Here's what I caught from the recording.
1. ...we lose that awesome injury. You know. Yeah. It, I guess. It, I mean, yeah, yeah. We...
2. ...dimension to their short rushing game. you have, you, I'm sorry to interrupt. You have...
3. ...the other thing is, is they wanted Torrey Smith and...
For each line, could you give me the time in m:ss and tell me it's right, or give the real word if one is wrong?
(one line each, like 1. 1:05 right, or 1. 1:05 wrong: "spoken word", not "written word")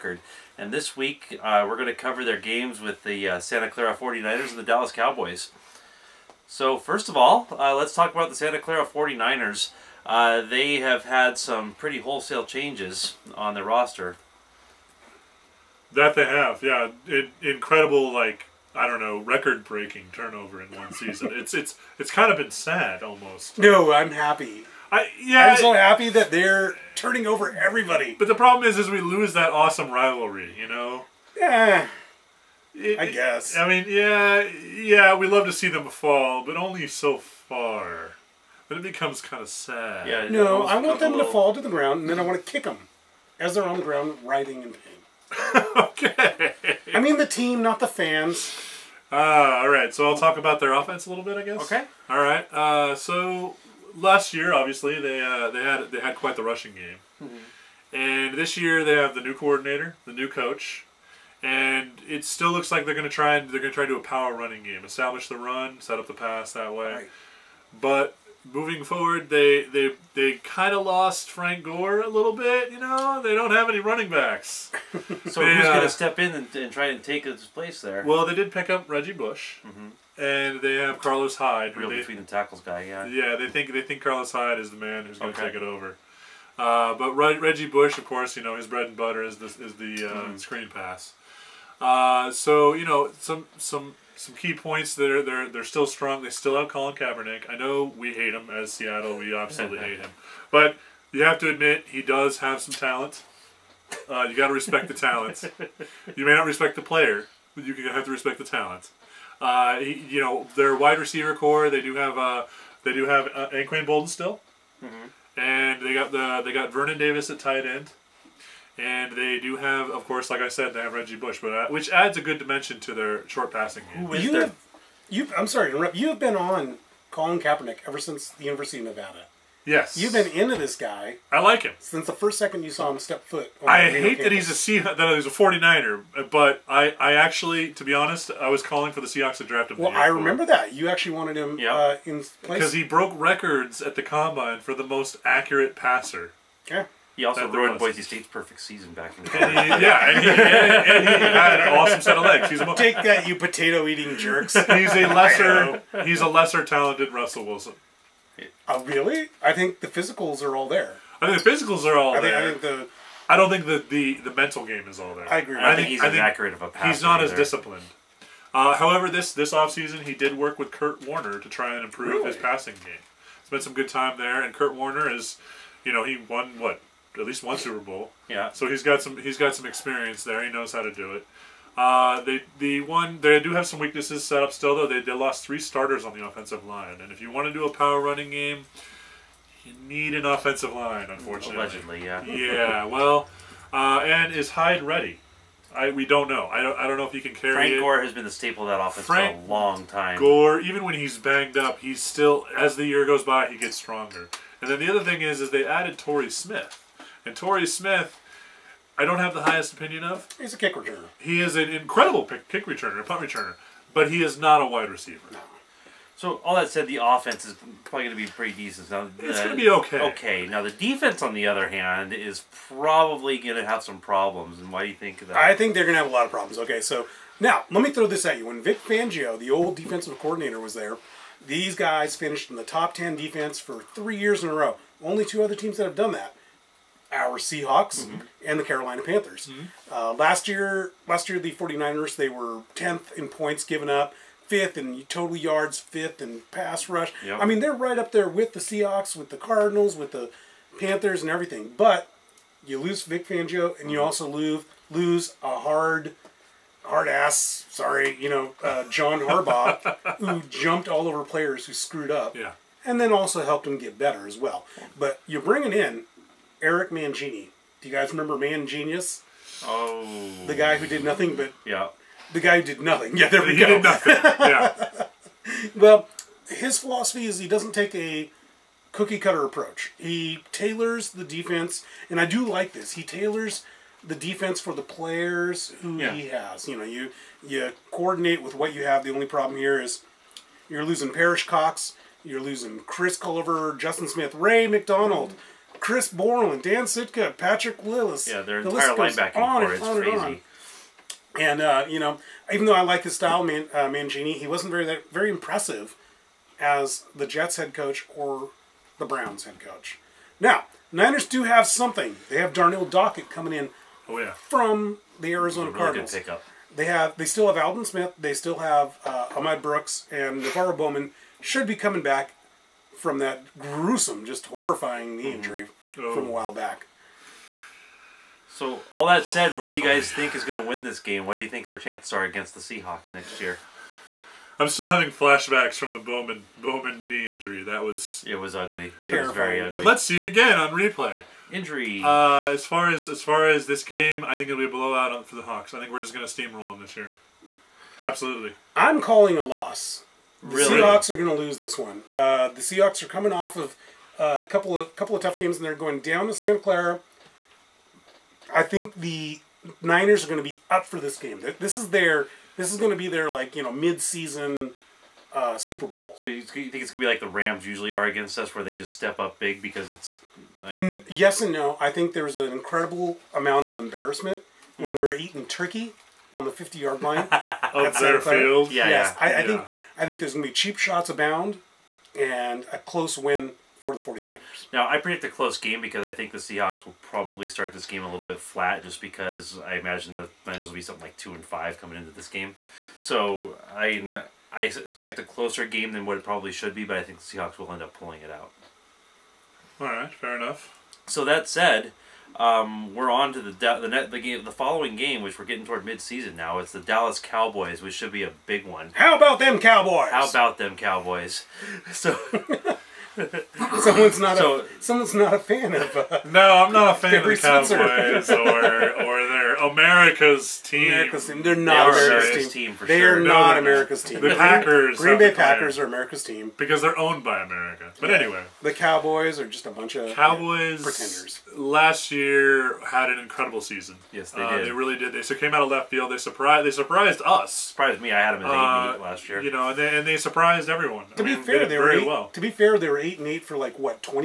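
1. 0:28 wrong: "rivalry", not "injury"
2. 2:02 wrong: "passing", not "rushing"
3. 3:24 wrong: "added", not "wanted".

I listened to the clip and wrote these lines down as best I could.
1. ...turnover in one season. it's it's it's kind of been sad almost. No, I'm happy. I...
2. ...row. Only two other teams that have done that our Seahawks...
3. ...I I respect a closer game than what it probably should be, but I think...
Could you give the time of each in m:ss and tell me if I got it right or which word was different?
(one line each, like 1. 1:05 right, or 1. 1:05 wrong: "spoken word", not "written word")
1. 0:20 right
2. 3:54 right
3. 6:33 wrong: "expect", not "respect".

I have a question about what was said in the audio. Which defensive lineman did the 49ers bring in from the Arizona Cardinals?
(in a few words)
Darnell Dockett.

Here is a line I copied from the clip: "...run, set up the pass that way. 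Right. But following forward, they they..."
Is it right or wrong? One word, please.
wrong.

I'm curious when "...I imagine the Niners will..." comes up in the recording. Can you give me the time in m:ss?
6:29.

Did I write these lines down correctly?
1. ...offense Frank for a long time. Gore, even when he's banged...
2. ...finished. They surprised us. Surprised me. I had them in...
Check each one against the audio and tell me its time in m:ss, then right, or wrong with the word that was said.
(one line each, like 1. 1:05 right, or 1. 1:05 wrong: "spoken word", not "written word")
1. 3:18 right
2. 7:16 wrong: "surprised", not "finished".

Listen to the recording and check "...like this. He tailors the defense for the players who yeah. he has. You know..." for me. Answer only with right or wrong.
right.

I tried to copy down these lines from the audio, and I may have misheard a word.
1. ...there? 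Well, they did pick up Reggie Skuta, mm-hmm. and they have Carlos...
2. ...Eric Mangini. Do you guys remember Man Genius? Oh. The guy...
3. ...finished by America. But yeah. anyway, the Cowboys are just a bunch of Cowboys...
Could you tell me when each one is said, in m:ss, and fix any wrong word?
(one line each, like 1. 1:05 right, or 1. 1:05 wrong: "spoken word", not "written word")
1. 1:17 wrong: "Bush", not "Skuta"
2. 4:26 right
3. 7:06 wrong: "owned", not "finished".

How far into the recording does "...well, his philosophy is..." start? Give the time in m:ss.
4:35.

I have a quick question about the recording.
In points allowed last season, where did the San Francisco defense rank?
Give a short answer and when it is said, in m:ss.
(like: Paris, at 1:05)
10th, at 4:02.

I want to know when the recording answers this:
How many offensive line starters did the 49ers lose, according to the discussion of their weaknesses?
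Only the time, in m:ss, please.
3:05.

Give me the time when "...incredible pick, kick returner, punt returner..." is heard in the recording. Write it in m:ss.
3:31.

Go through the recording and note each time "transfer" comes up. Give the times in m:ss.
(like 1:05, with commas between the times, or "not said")
not said.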